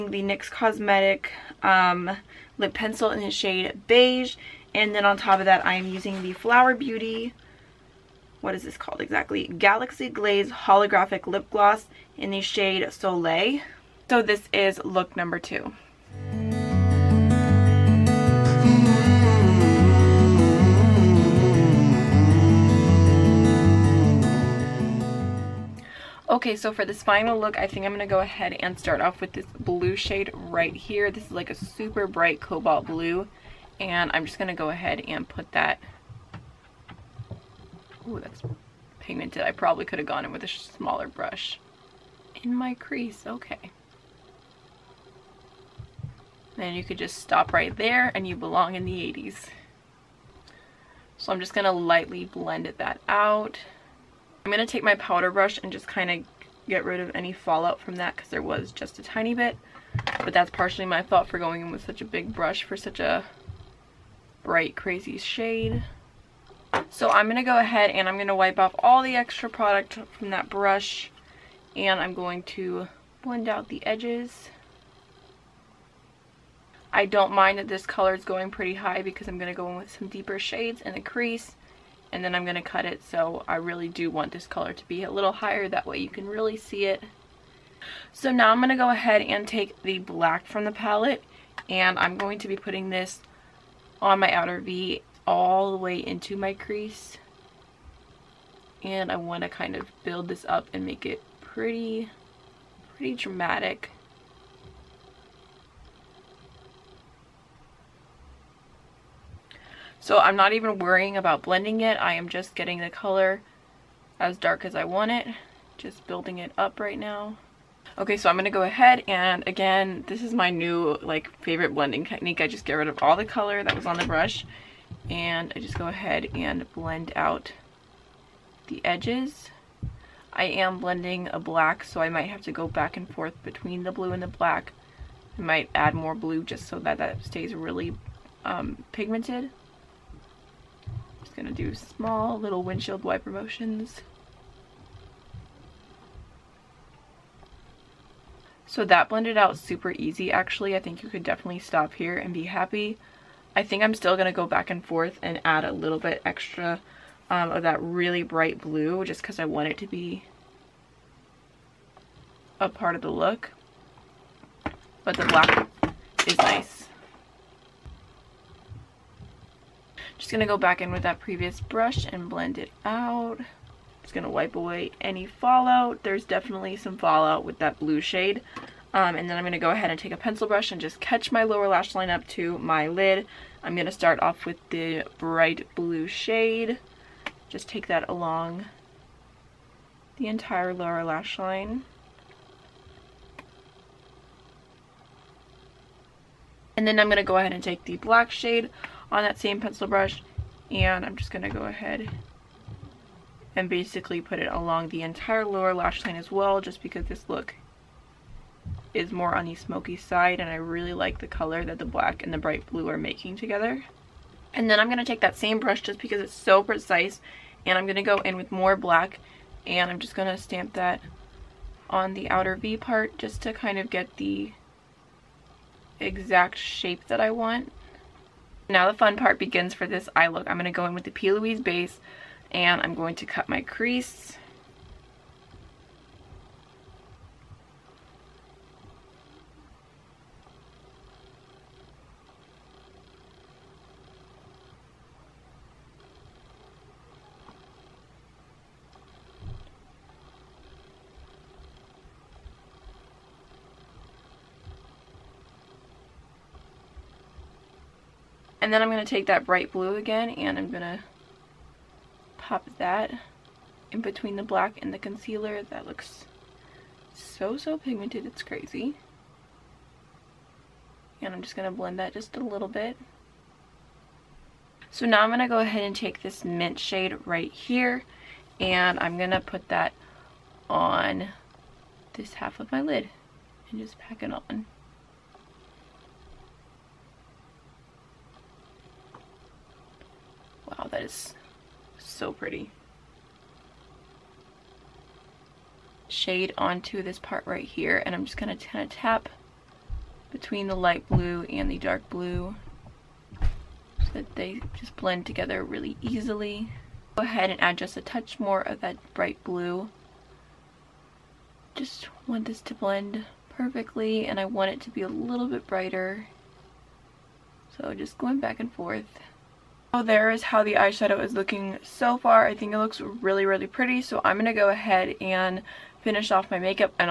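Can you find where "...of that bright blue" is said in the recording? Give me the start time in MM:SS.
05:08.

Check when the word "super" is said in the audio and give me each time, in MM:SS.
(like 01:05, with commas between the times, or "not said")
00:31, 02:29.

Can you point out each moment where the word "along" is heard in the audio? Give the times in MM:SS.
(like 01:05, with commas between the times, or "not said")
03:08, 03:24.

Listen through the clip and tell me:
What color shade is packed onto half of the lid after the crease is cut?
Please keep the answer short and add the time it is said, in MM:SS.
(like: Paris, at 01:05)
mint, at 04:36.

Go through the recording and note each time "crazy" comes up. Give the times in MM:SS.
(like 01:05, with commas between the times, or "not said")
01:04, 04:28.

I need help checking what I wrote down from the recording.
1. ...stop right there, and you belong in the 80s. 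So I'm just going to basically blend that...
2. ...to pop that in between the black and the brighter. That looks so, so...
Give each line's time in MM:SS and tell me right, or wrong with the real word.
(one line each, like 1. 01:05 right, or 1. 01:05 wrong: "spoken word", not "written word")
1. 00:47 wrong: "lightly", not "basically"
2. 04:20 wrong: "concealer", not "brighter".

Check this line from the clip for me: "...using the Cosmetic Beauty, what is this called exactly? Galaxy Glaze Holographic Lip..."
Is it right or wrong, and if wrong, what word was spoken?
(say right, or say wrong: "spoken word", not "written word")
wrong: "Flower", not "Cosmetic".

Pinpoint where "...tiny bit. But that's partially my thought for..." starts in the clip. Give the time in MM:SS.
00:59.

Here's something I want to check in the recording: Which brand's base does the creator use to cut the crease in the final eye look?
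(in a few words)
P. Louise.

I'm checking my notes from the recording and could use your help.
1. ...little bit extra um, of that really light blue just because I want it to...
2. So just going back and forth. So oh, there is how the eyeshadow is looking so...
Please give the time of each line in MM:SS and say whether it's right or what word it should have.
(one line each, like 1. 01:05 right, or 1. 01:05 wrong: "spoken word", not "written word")
1. 02:35 wrong: "bright", not "light"
2. 05:17 right.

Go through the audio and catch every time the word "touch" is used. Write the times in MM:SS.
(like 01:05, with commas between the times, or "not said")
05:08.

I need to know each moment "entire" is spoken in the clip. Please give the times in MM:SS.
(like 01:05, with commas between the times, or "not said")
03:10, 03:25.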